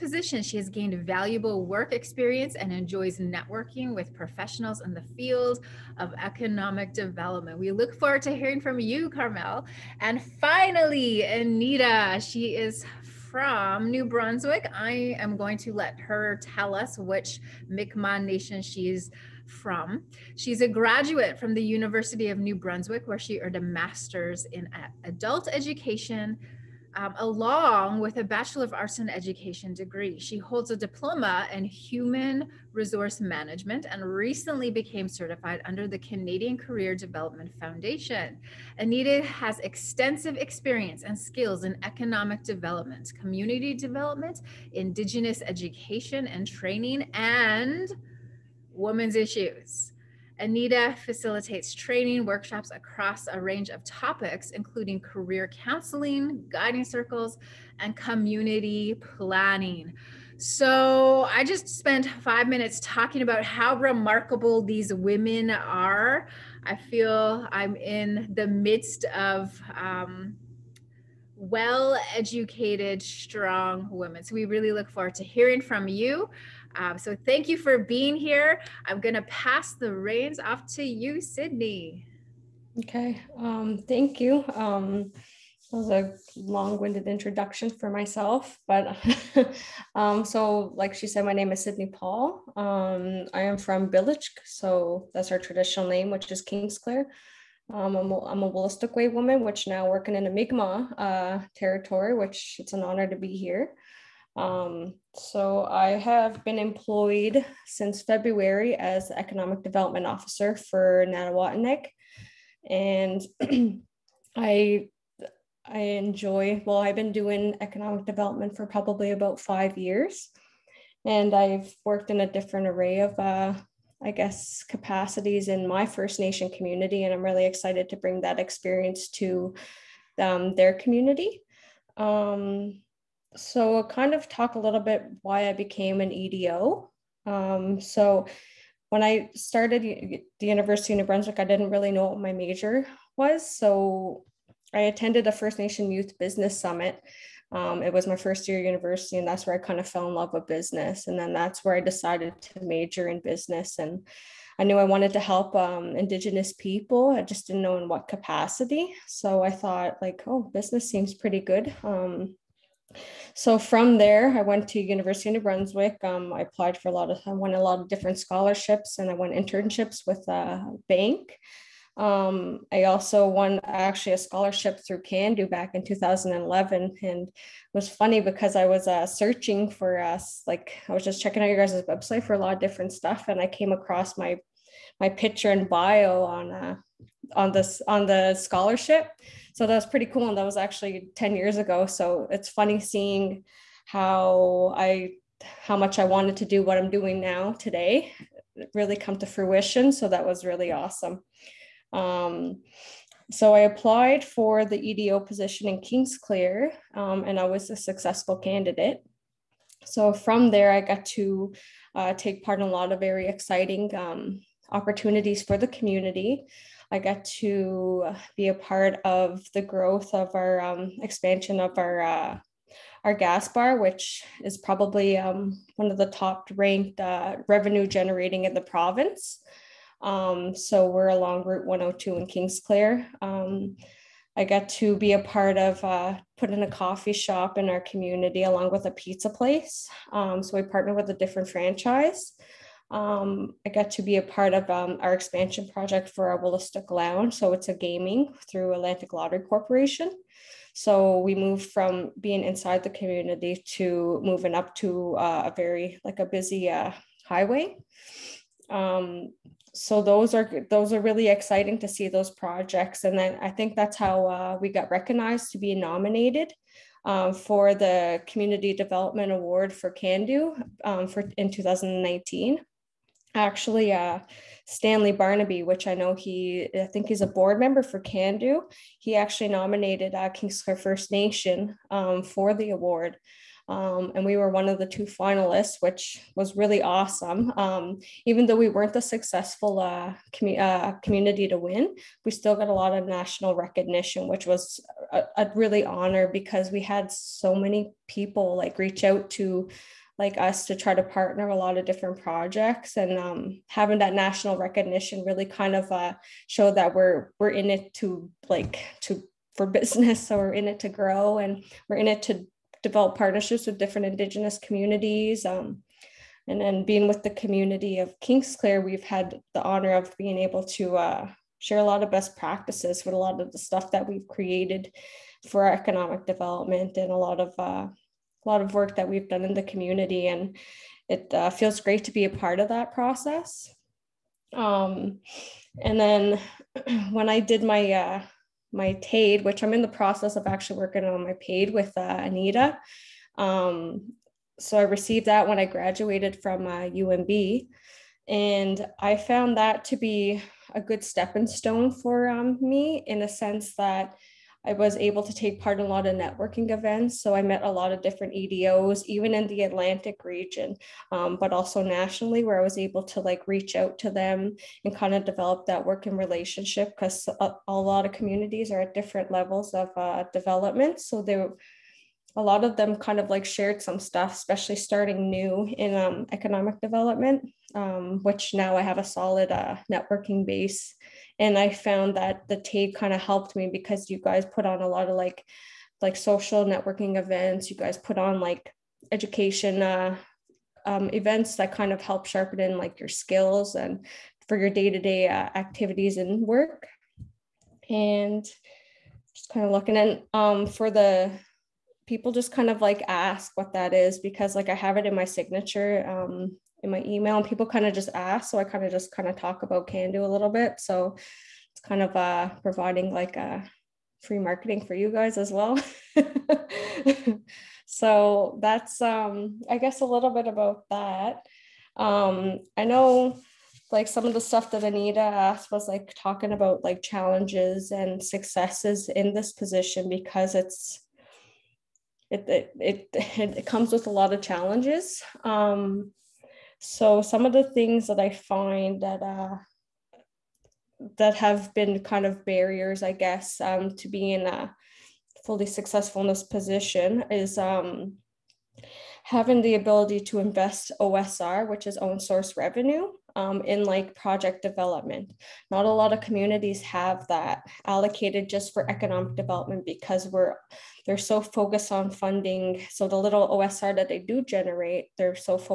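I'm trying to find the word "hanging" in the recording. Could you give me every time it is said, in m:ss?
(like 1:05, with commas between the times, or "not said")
not said.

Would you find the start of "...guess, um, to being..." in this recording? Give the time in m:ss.
7:23.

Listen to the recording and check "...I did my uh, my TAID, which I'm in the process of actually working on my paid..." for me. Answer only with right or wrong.
right.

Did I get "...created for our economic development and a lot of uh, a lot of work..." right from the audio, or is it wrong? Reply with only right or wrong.
right.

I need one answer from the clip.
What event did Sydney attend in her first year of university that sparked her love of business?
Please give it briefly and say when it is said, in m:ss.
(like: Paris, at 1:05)
First Nation Youth Business Summit, at 2:25.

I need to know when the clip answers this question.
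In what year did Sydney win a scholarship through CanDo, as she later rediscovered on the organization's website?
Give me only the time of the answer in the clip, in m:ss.
2:55.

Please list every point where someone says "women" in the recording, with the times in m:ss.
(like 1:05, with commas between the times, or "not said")
0:48, 1:04, 1:13.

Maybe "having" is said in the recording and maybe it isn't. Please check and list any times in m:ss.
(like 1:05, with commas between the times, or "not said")
5:03, 7:29.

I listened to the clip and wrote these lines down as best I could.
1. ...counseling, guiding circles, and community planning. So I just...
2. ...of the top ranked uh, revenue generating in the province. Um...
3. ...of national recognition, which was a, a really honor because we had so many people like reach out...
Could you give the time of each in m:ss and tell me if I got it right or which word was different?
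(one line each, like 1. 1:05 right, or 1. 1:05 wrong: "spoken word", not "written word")
1. 0:55 right
2. 3:45 right
3. 4:52 right.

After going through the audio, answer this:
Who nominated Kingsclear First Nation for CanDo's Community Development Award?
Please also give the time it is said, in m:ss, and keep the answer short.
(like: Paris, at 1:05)
Stanley Barnaby, at 4:34.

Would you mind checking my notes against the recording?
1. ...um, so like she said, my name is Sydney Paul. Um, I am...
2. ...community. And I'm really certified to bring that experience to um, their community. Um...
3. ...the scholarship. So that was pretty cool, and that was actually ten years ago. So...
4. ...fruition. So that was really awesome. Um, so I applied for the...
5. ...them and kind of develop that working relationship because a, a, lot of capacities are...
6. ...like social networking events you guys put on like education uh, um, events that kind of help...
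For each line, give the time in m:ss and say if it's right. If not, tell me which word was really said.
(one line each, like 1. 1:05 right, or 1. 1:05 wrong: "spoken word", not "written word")
1. 1:29 right
2. 2:06 wrong: "excited", not "certified"
3. 3:08 right
4. 3:19 right
5. 6:04 wrong: "communities", not "capacities"
6. 6:25 right.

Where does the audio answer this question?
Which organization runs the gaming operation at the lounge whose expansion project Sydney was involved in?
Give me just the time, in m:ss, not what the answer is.
4:08.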